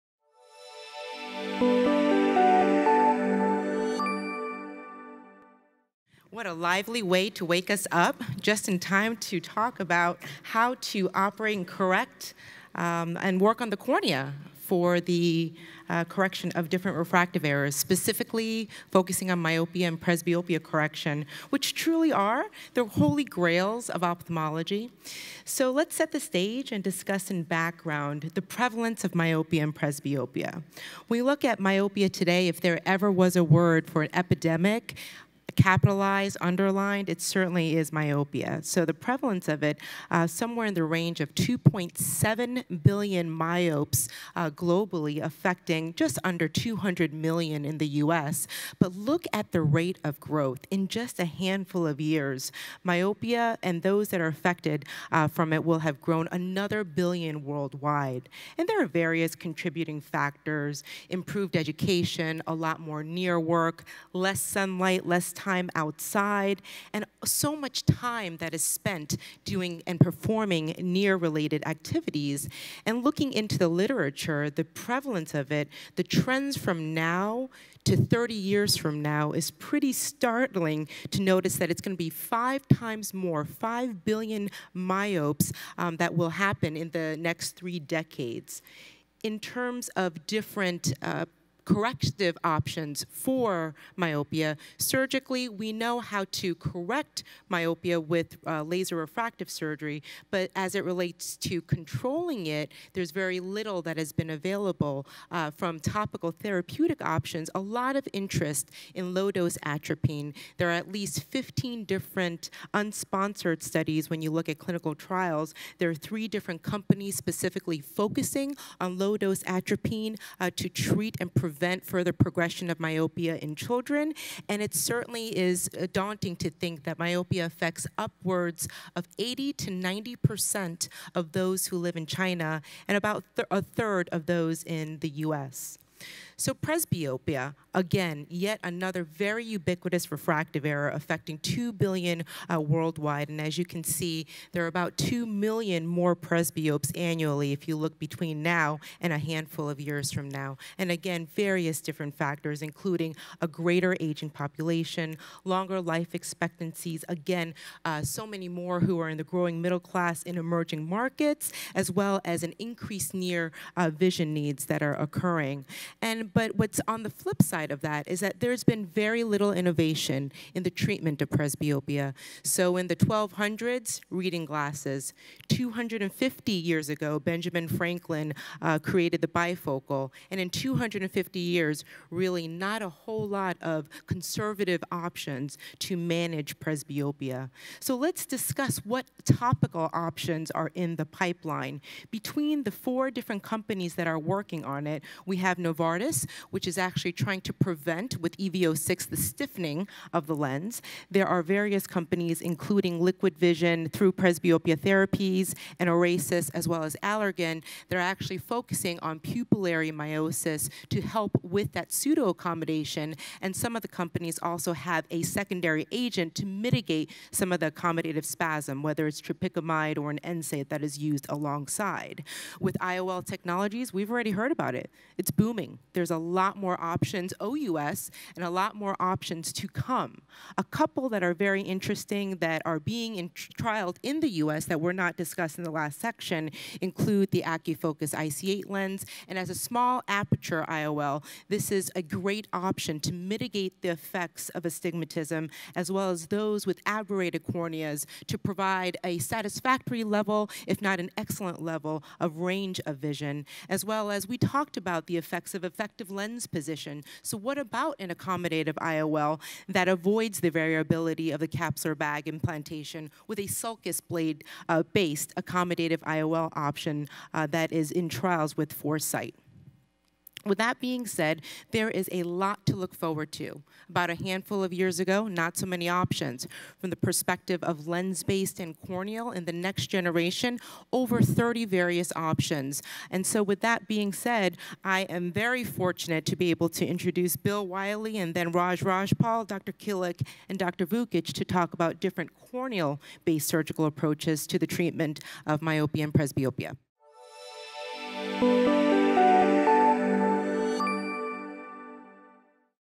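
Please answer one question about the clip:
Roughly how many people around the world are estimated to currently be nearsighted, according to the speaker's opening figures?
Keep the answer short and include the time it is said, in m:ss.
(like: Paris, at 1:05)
2.7 billion, at 0:41.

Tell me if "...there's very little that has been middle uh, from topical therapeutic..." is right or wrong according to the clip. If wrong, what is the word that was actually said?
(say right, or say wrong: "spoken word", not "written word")
wrong: "available", not "middle".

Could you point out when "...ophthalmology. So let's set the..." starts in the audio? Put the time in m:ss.
0:24.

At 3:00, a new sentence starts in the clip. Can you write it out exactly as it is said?
And in 250 years, really not a whole lot of conservative options to manage presbyopia.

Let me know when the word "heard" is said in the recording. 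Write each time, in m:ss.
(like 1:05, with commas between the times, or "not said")
3:44.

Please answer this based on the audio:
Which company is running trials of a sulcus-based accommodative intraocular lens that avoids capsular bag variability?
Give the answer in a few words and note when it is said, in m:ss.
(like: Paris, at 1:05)
Foresight, at 4:28.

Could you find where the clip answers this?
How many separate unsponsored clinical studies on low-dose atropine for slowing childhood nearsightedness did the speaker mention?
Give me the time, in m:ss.
1:51.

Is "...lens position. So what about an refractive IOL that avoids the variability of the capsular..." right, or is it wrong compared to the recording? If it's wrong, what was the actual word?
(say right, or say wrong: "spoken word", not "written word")
wrong: "accommodative", not "refractive".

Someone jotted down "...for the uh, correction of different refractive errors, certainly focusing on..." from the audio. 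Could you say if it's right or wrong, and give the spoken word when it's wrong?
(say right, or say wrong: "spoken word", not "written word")
wrong: "specifically", not "certainly".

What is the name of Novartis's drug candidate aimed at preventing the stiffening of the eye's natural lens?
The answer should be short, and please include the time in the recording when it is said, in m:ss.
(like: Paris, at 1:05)
EV06, at 3:18.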